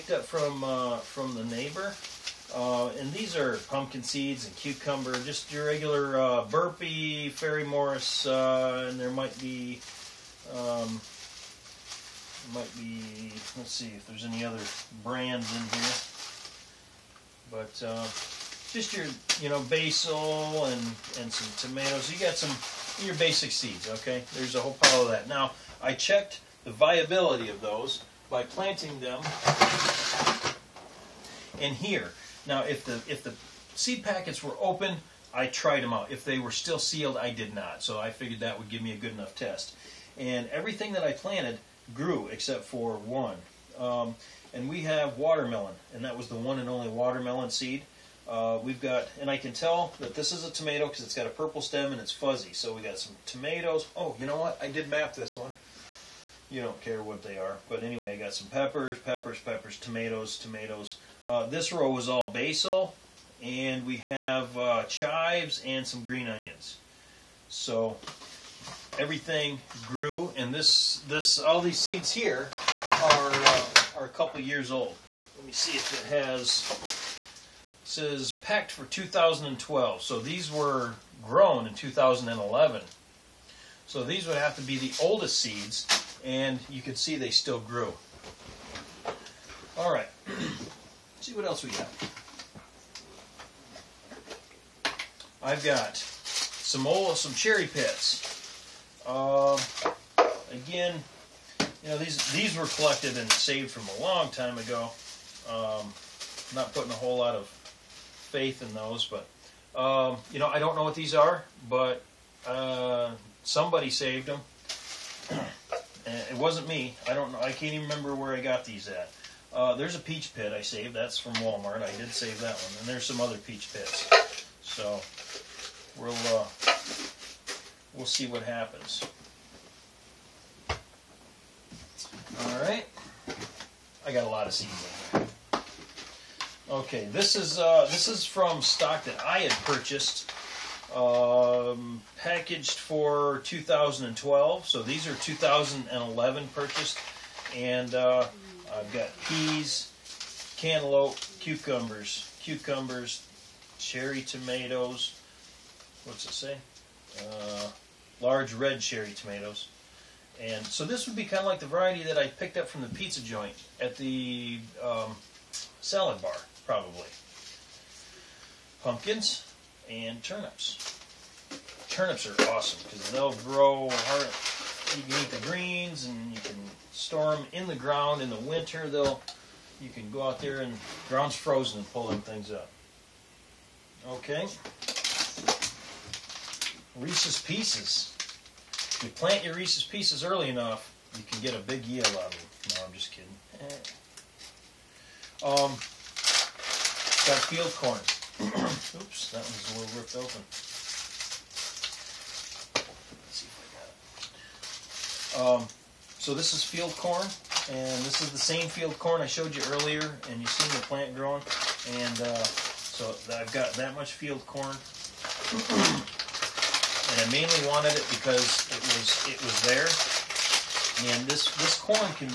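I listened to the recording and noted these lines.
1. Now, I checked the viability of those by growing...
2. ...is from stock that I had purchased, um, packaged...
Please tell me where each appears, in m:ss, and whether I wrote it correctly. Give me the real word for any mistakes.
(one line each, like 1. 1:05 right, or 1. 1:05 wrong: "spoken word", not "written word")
1. 0:25 wrong: "planting", not "growing"
2. 2:18 right.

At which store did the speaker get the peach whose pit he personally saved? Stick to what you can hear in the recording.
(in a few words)
Walmart.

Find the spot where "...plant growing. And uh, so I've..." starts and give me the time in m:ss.
3:30.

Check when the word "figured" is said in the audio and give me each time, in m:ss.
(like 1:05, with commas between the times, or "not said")
0:38.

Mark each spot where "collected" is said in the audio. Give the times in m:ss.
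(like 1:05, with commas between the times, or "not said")
1:42.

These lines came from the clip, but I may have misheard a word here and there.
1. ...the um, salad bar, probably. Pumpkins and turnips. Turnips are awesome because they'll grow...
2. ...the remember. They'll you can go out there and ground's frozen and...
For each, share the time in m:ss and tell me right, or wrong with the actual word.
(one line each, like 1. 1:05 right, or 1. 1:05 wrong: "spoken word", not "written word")
1. 2:43 right
2. 2:58 wrong: "winter", not "remember".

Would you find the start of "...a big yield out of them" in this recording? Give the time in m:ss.
3:11.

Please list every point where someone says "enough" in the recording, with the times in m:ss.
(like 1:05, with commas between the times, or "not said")
0:39, 3:10.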